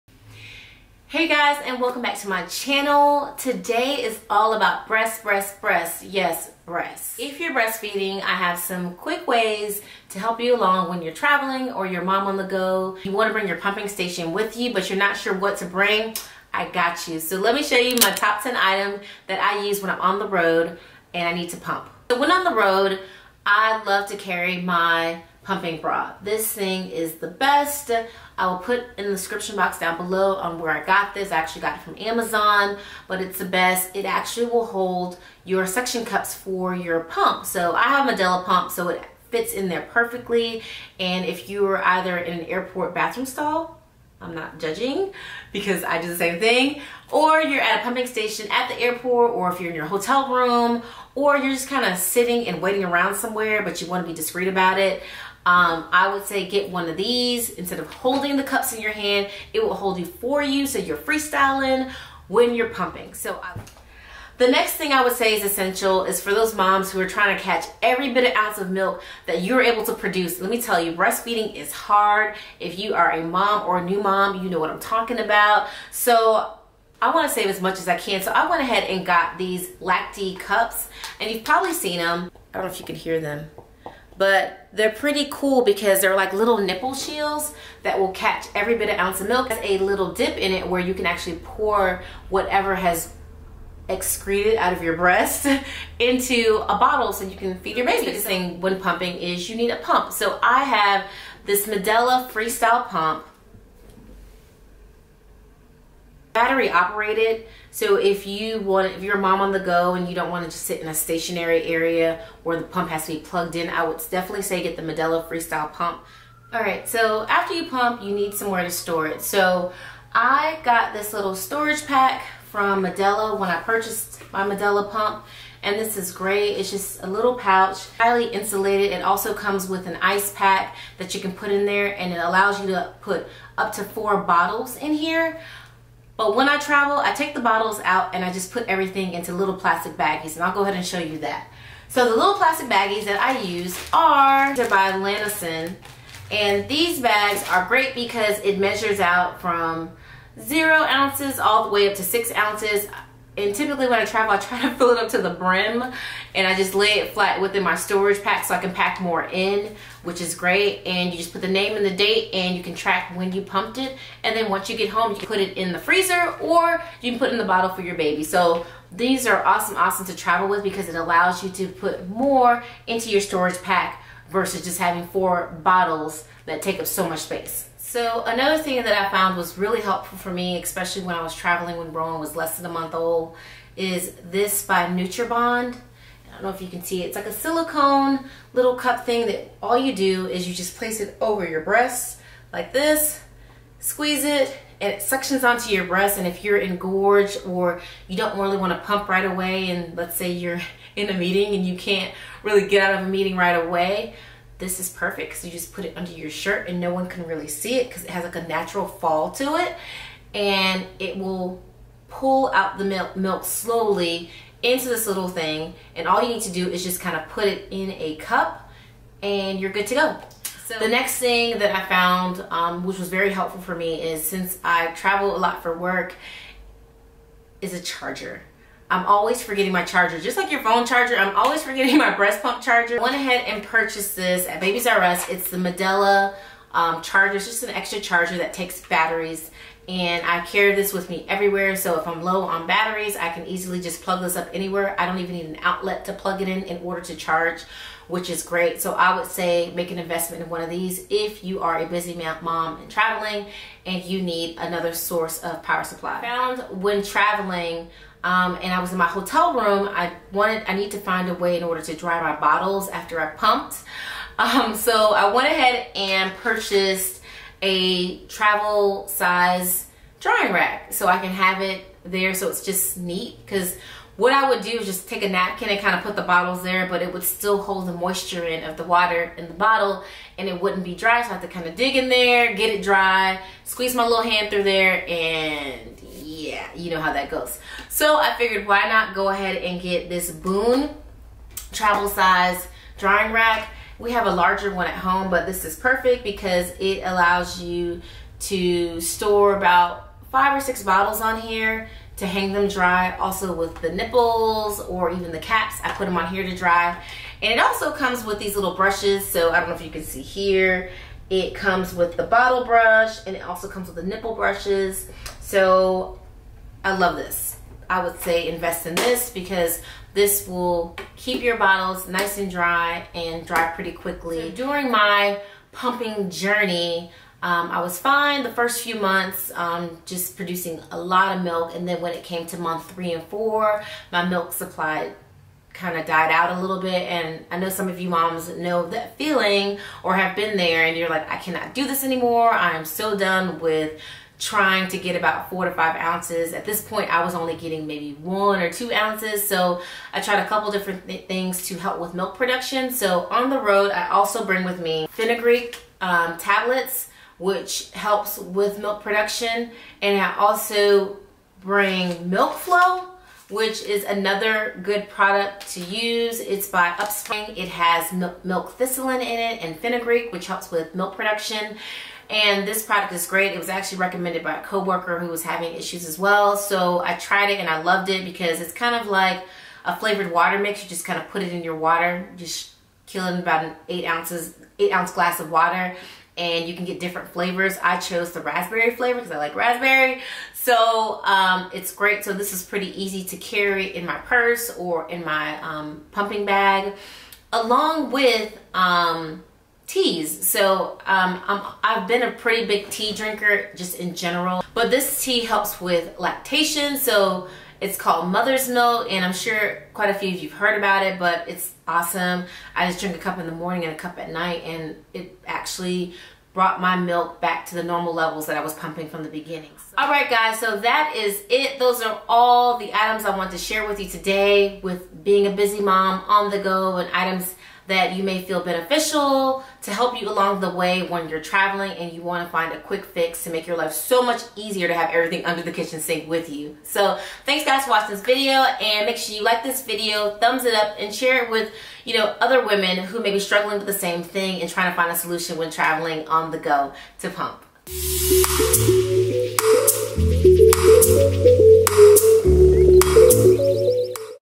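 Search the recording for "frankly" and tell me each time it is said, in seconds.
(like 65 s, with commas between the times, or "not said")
not said.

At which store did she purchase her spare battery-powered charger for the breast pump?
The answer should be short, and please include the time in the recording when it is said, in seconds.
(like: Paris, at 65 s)
Babies R Us, at 234 s.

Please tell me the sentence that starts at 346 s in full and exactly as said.
At this point, I was only getting maybe one or two ounces.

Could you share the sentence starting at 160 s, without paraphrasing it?
And you just put the name and the date and you can track when you pumped it.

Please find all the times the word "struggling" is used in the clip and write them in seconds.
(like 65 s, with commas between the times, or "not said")
443 s.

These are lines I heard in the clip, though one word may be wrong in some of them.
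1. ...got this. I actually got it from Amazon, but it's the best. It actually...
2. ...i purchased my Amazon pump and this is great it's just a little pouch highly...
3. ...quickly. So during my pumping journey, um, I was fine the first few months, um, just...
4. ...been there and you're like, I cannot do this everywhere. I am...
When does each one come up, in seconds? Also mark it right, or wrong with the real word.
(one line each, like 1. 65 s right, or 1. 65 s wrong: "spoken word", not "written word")
1. 30 s right
2. 123 s wrong: "Medela", not "Amazon"
3. 323 s right
4. 340 s wrong: "anymore", not "everywhere".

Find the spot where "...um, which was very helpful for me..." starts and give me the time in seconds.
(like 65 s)
222 s.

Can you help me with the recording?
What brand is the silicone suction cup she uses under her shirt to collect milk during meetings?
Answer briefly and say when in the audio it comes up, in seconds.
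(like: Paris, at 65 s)
NatureBond, at 184 s.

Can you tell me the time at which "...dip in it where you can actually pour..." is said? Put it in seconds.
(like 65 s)
90 s.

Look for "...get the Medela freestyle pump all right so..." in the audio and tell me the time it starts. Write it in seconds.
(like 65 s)
114 s.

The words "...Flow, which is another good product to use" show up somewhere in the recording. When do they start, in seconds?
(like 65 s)
362 s.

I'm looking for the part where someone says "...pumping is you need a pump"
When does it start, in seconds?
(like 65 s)
98 s.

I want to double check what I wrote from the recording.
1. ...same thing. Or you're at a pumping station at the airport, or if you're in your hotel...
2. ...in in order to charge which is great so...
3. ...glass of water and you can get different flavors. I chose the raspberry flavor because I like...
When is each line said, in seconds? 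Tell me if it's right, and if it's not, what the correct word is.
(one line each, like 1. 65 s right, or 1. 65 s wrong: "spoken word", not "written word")
1. 46 s right
2. 246 s right
3. 385 s right.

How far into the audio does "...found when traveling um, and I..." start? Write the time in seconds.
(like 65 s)
256 s.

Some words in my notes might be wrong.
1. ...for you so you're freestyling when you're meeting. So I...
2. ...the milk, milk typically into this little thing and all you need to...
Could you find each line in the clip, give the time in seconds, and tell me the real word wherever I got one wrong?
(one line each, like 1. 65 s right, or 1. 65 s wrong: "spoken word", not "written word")
1. 60 s wrong: "pumping", not "meeting"
2. 212 s wrong: "slowly", not "typically".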